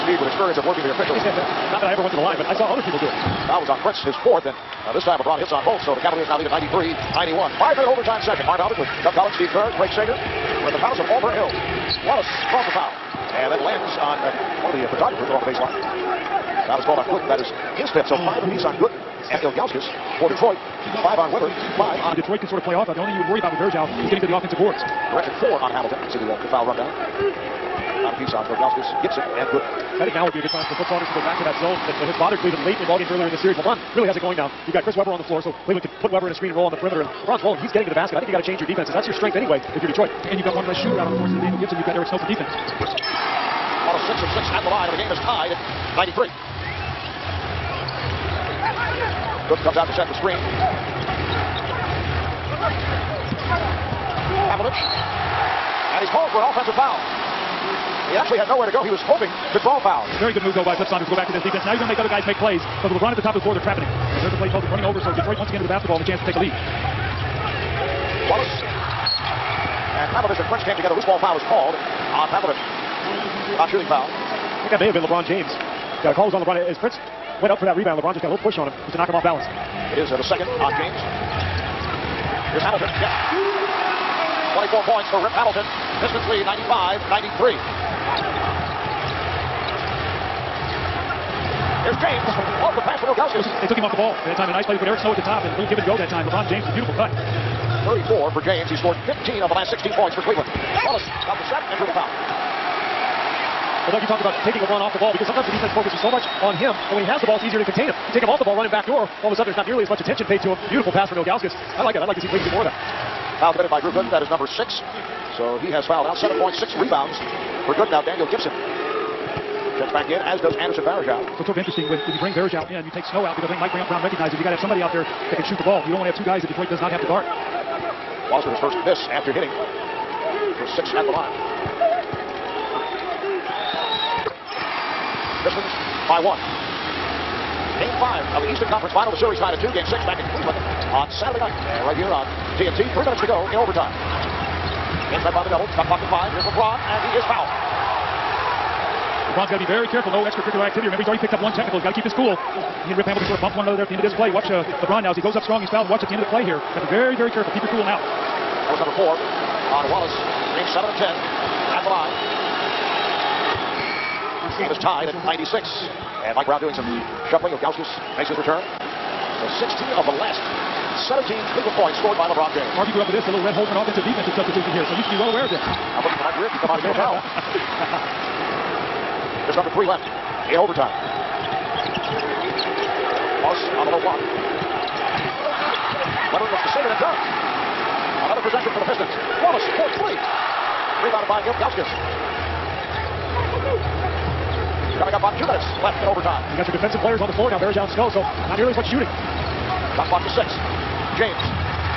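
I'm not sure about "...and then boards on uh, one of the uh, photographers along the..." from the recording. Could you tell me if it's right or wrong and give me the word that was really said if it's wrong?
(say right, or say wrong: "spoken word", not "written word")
wrong: "lands", not "boards".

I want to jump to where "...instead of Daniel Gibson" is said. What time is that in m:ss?
0:41.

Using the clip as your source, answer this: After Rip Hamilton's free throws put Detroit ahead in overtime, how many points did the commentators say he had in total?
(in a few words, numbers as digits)
24.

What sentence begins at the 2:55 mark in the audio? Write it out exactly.
I'm looking for Mike Rick to come out and give a foul.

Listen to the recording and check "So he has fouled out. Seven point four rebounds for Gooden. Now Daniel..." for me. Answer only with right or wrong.
wrong.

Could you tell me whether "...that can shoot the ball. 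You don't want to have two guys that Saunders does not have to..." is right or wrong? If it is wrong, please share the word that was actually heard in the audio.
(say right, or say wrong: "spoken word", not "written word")
wrong: "Detroit", not "Saunders".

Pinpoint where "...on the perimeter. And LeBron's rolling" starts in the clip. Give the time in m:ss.
0:36.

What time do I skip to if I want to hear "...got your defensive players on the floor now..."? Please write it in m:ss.
3:16.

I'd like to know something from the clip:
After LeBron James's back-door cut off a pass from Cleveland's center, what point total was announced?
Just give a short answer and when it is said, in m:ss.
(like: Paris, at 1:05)
34, at 1:37.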